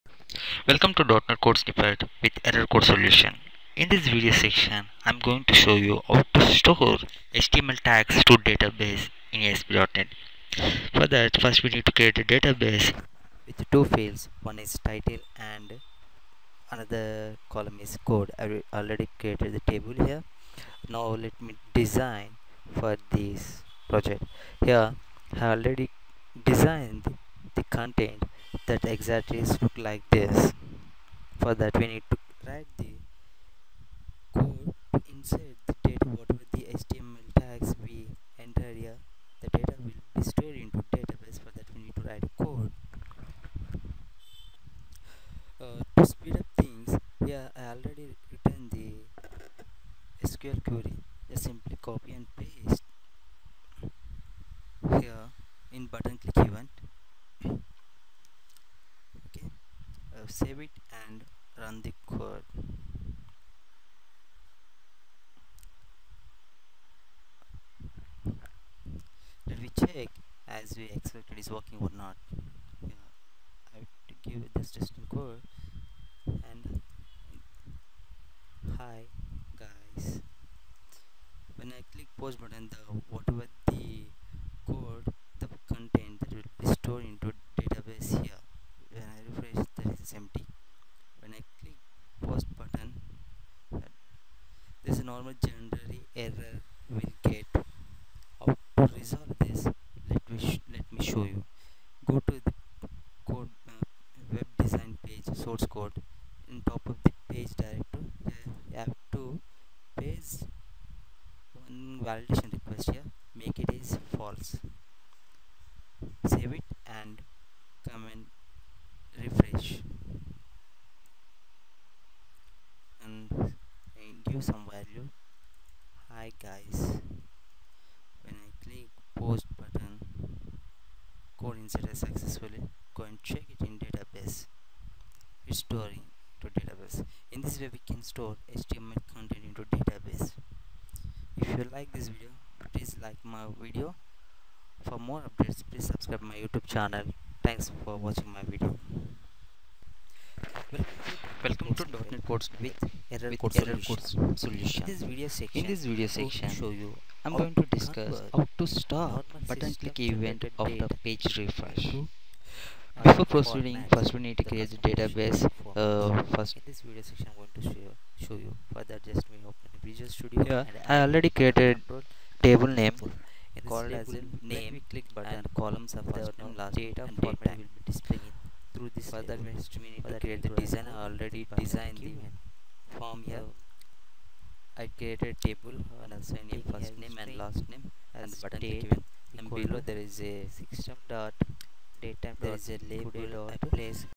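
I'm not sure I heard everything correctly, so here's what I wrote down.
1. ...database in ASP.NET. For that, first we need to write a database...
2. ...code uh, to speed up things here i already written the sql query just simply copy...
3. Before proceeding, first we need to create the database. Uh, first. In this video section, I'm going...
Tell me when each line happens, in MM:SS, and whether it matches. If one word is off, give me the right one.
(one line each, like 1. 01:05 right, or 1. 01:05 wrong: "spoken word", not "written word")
1. 00:08 wrong: "create", not "write"
2. 00:42 right
3. 02:43 right.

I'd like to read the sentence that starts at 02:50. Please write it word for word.
Yeah, I already created table name called as name.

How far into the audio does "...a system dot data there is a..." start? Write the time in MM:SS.
03:10.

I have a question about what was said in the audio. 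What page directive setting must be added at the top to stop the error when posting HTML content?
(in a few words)
validation request.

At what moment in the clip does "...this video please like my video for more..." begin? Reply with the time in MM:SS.
02:21.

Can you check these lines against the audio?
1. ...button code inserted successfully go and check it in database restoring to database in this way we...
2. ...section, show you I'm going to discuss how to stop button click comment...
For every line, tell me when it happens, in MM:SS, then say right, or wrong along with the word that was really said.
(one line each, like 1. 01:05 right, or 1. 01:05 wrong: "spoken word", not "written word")
1. 02:09 right
2. 02:36 wrong: "event", not "comment".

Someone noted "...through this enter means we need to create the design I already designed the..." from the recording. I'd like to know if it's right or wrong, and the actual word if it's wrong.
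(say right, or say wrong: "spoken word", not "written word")
wrong: "further", not "enter".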